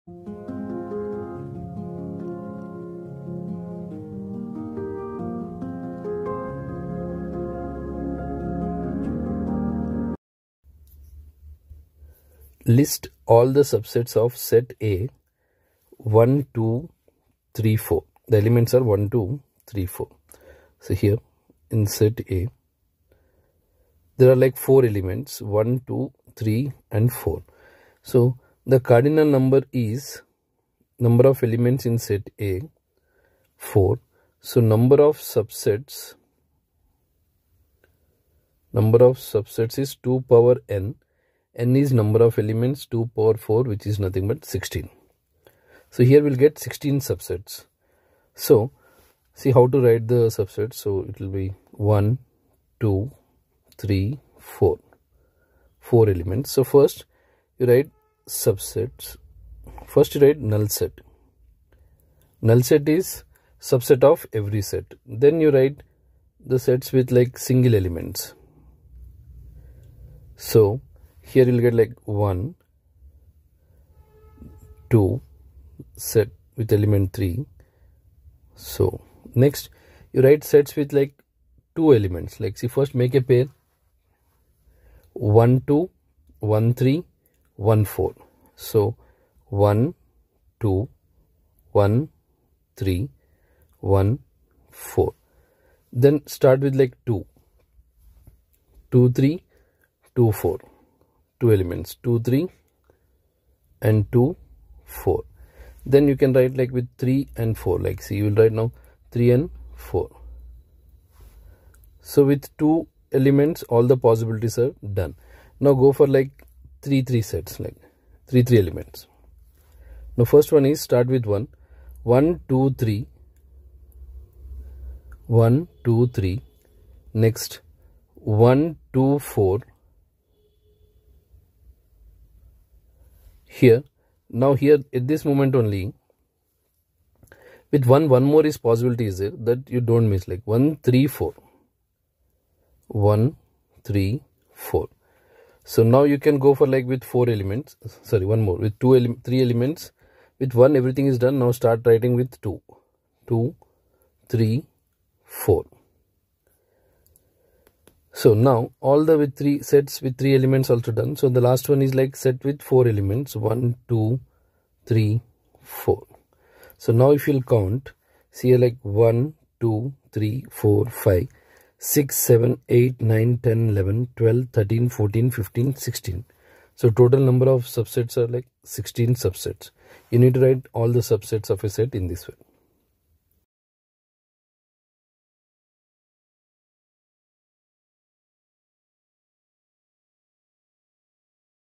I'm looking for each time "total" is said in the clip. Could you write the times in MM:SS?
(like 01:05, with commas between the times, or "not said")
02:56.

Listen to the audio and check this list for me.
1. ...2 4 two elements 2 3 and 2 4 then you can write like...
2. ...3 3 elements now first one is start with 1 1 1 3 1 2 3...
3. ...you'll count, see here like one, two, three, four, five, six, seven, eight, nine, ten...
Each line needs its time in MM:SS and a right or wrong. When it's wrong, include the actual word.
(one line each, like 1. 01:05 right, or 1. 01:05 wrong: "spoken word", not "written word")
1. 01:40 right
2. 01:58 wrong: "2", not "1"
3. 02:47 right.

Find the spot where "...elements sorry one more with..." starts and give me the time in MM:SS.
02:27.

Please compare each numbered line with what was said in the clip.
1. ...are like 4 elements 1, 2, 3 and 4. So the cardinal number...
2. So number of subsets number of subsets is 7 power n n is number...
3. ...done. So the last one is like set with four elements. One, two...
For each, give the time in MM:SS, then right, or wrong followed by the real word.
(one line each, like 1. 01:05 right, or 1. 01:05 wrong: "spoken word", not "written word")
1. 00:24 right
2. 00:34 wrong: "2", not "7"
3. 02:40 right.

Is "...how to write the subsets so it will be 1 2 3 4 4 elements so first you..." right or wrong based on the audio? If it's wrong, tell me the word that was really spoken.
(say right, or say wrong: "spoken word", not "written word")
right.